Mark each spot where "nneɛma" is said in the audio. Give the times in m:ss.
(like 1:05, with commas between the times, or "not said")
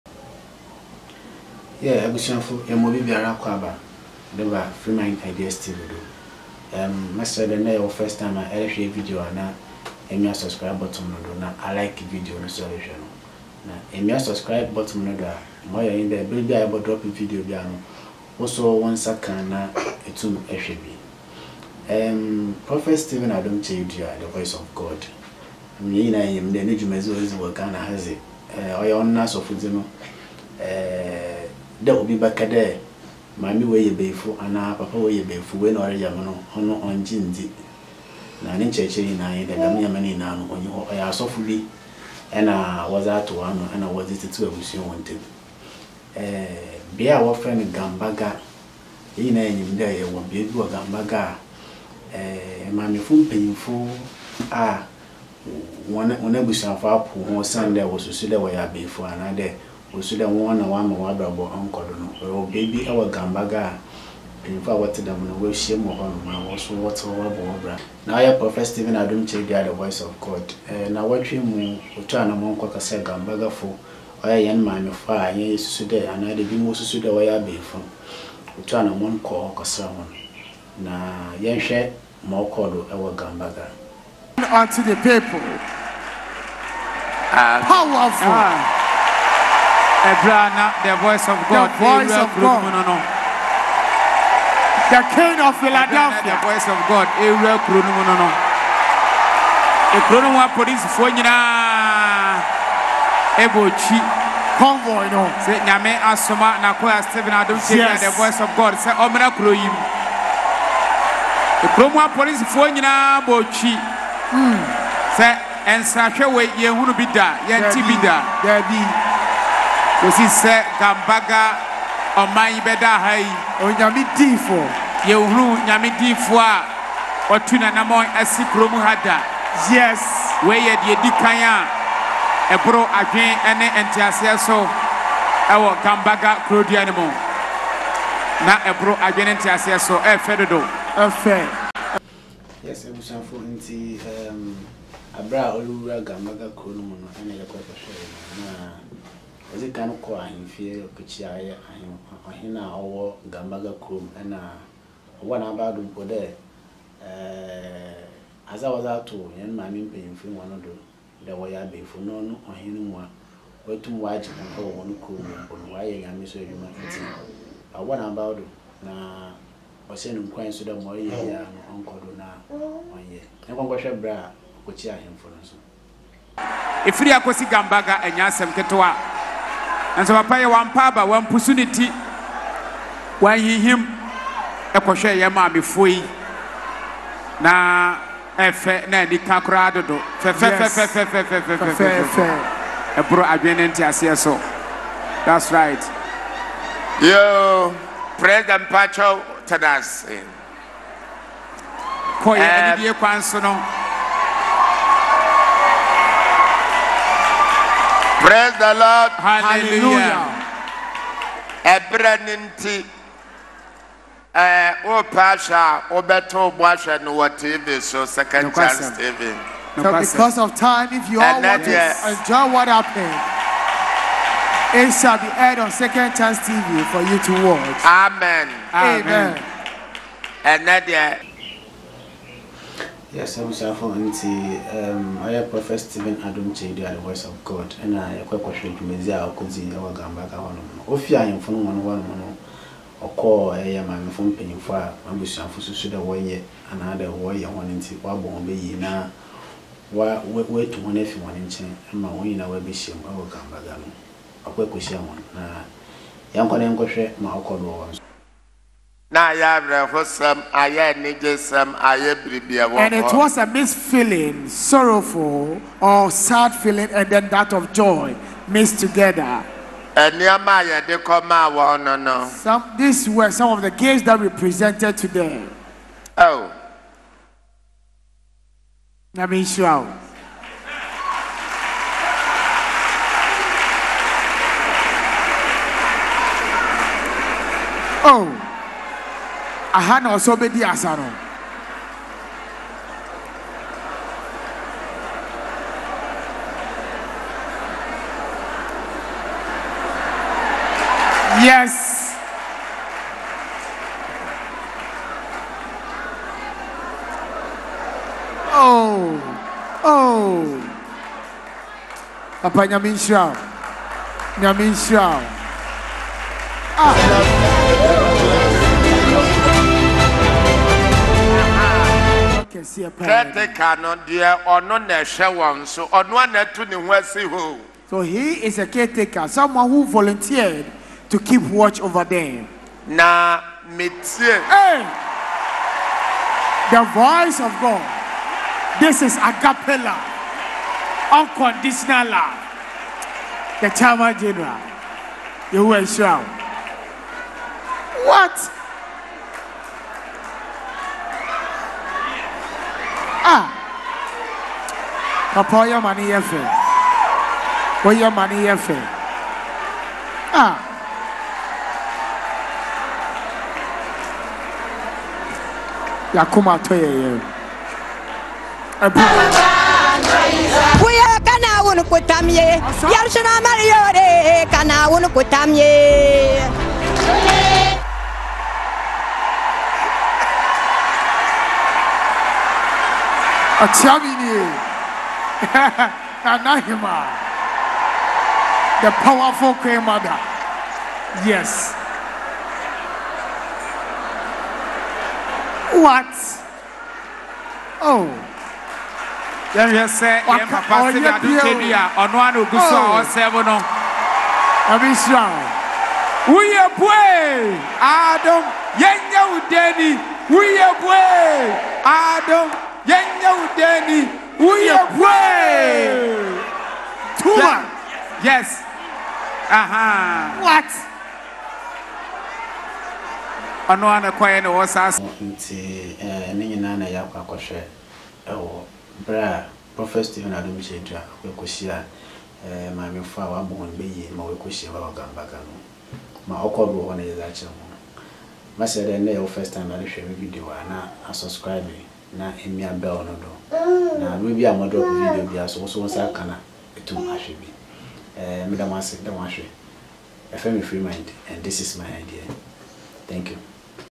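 0:39, 7:24.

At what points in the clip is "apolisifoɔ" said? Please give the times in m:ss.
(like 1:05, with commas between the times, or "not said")
1:40, 1:51.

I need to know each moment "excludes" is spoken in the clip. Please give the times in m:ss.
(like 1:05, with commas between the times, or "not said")
not said.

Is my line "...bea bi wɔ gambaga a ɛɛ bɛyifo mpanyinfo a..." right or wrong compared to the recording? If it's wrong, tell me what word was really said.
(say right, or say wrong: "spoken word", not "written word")
wrong: "maamefo", not "bɛyifo".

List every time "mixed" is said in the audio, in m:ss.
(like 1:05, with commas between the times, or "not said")
4:23, 4:28.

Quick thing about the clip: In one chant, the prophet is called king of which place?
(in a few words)
The king of Philadelphia.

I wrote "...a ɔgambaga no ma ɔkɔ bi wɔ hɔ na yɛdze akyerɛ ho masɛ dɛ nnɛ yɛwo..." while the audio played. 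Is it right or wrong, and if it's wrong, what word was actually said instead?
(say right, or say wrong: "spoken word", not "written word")
right.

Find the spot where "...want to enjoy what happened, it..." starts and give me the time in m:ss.
3:41.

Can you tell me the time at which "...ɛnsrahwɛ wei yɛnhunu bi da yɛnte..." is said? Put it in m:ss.
1:55.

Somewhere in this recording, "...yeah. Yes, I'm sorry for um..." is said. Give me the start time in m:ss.
3:50.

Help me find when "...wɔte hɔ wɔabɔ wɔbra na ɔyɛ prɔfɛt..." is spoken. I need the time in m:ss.
1:06.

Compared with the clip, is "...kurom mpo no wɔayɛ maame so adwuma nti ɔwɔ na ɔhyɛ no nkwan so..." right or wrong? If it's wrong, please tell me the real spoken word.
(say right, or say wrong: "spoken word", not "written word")
wrong: "nyame", not "maame".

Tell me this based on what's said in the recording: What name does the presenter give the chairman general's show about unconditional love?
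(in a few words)
agapela.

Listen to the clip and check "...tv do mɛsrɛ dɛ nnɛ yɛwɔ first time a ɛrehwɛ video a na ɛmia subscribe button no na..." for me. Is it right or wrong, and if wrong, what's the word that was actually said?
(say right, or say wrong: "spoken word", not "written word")
right.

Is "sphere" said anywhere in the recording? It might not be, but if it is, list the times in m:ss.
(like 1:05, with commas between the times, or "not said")
not said.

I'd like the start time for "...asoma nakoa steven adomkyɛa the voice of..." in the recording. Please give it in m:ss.
1:45.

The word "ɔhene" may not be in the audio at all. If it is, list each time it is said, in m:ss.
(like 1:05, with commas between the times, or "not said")
2:32, 2:41.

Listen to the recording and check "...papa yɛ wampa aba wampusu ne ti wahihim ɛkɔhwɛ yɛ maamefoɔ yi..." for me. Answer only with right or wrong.
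right.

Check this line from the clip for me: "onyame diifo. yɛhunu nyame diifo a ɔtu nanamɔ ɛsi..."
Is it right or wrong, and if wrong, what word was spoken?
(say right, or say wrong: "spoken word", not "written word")
right.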